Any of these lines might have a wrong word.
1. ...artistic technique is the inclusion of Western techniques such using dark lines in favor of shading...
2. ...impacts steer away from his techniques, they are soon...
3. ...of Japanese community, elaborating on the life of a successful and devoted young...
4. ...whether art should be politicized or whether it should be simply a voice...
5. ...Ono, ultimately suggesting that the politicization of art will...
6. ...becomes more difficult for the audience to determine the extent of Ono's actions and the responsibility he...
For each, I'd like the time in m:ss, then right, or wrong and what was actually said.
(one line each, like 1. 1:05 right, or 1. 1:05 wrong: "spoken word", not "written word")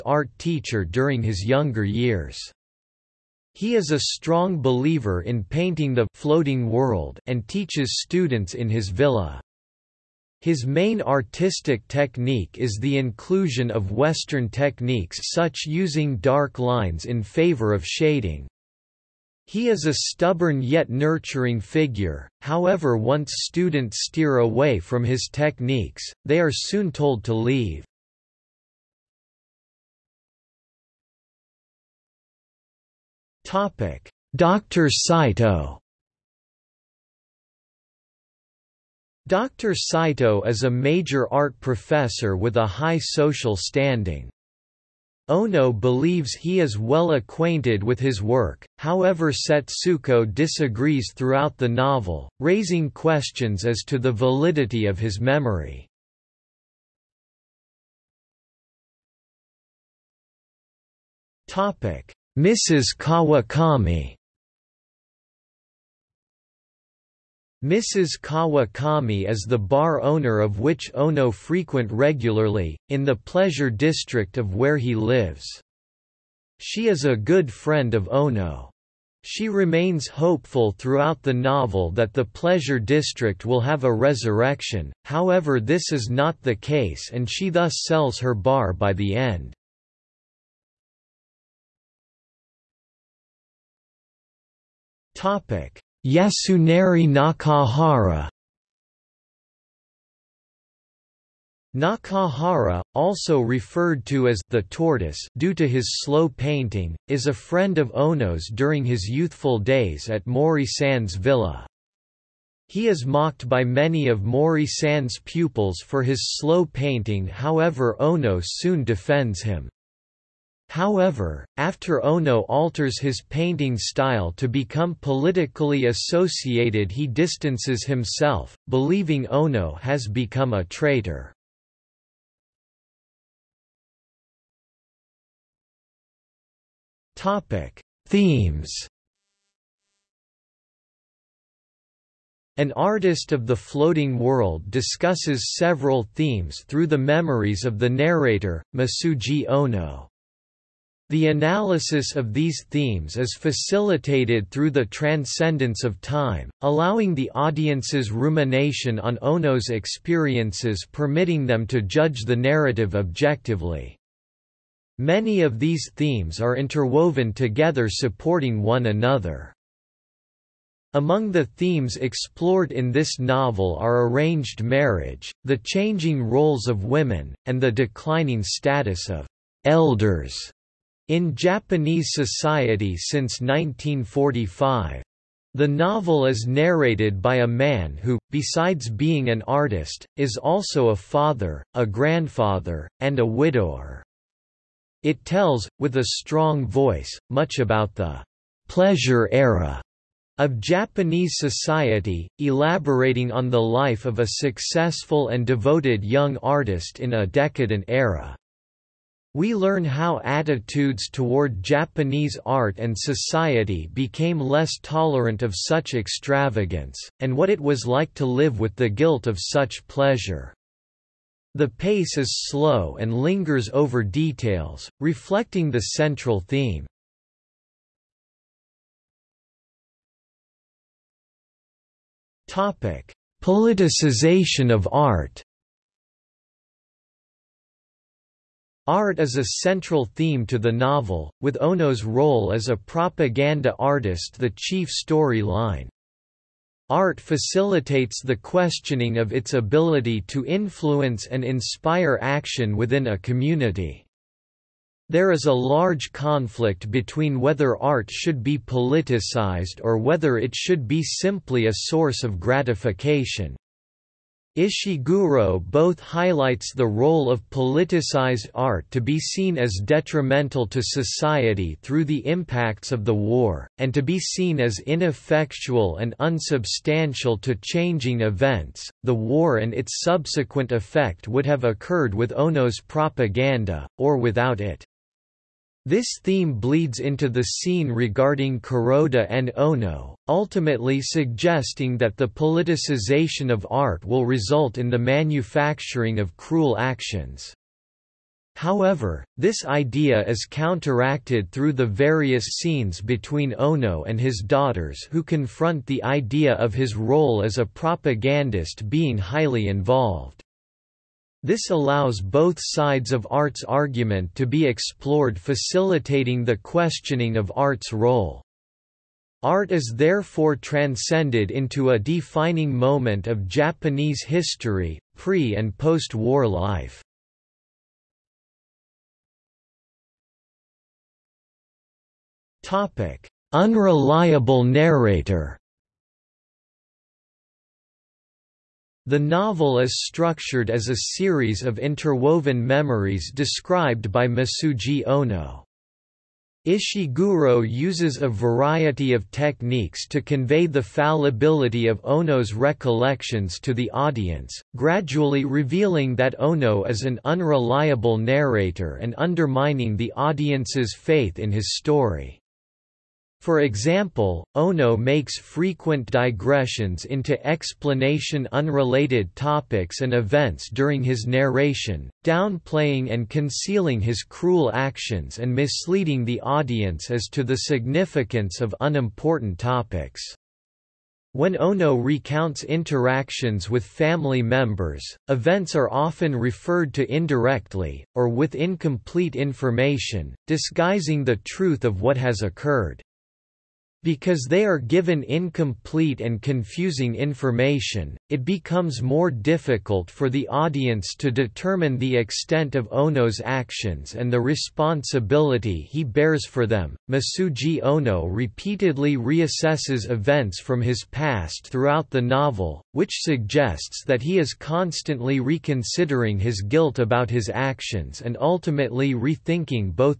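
1. 0:11 right
2. 0:23 wrong: "students", not "impacts"
3. 3:20 wrong: "society", not "community"
4. 4:17 wrong: "source", not "voice"
5. 4:49 right
6. 6:38 right.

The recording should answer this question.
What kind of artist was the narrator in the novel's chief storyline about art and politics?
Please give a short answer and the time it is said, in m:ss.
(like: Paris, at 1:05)
propaganda artist, at 4:02.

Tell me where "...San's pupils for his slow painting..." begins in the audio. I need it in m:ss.
1:54.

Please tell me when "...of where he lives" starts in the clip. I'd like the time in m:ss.
1:14.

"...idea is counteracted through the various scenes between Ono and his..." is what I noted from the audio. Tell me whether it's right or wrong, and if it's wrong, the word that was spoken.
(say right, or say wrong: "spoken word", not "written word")
right.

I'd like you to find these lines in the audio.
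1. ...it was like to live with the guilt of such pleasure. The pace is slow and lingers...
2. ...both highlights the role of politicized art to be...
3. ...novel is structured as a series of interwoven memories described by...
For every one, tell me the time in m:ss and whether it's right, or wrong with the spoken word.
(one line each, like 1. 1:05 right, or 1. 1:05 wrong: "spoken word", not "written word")
1. 3:37 right
2. 4:25 right
3. 5:39 right.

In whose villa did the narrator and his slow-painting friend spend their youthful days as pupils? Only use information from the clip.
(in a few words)
Mori San's villa.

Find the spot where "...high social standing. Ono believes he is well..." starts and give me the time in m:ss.
0:42.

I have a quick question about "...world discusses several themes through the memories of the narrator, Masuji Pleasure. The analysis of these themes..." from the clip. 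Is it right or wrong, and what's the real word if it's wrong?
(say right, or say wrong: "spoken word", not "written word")
wrong: "Ono", not "Pleasure".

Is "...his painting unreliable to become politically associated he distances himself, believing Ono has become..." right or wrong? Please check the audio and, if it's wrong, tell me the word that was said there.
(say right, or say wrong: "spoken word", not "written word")
wrong: "style", not "unreliable".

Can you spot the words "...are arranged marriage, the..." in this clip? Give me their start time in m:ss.
2:53.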